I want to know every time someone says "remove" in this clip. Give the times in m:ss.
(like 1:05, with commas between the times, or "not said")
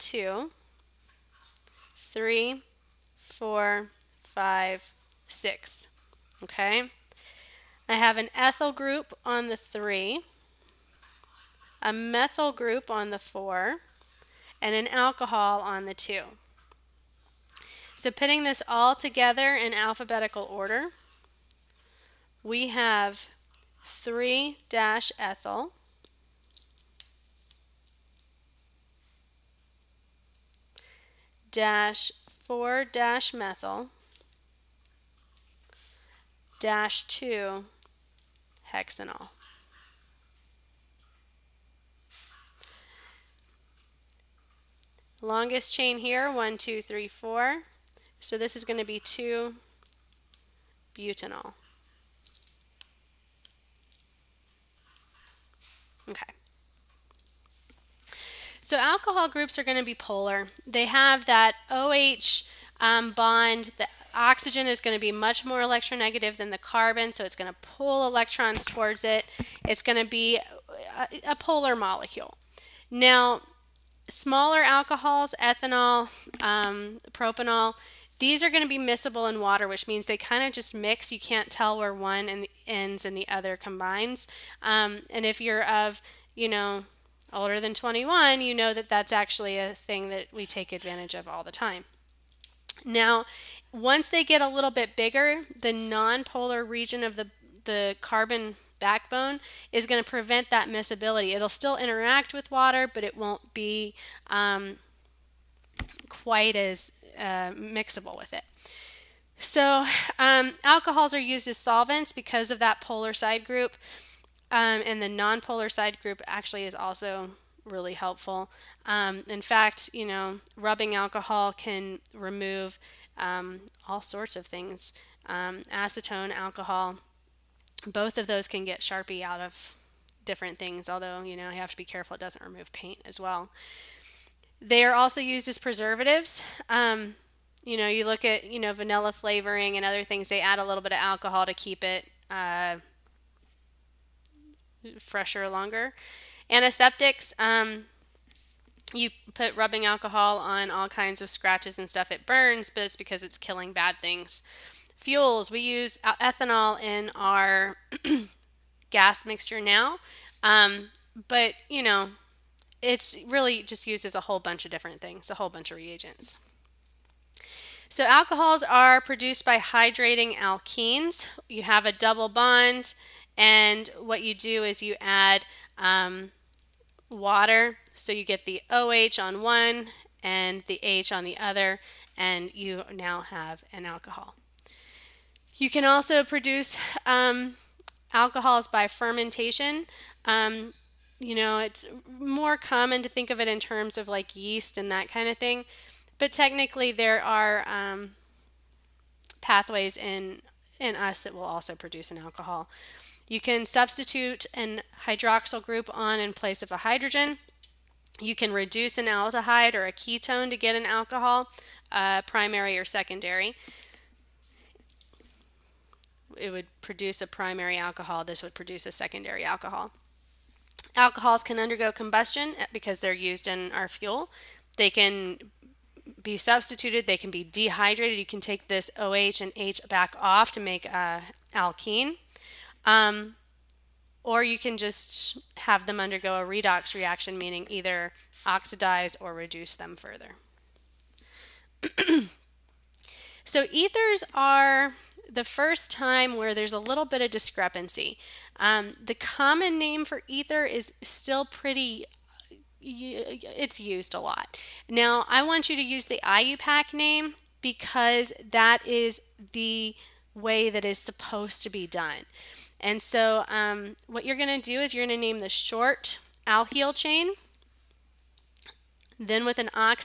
2:02, 2:12.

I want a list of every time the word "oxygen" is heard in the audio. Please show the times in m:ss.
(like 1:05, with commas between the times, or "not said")
1:04.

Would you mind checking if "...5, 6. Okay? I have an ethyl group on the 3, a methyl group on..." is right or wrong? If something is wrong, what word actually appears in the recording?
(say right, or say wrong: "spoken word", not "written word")
right.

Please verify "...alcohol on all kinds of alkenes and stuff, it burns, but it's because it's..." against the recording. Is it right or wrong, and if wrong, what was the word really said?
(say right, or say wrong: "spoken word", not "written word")
wrong: "scratches", not "alkenes".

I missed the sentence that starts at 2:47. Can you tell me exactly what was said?
So alcohols are produced by hydrating alkenes.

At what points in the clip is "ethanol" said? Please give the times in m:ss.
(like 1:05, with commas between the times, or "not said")
1:15, 2:35.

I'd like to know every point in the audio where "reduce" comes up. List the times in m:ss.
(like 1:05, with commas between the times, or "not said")
3:28, 3:59.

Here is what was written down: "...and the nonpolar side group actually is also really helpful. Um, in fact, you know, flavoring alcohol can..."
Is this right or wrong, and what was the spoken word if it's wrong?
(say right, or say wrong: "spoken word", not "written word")
wrong: "rubbing", not "flavoring".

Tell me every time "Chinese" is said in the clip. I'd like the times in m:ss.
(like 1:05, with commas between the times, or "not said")
not said.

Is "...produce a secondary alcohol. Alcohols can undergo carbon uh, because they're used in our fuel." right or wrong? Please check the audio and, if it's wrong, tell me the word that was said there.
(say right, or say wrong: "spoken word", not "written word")
wrong: "combustion", not "carbon".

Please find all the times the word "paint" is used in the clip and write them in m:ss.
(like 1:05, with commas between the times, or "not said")
2:12.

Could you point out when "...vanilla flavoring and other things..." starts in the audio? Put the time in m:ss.
2:18.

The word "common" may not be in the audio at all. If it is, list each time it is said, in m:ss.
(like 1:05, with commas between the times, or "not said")
3:12, 4:09.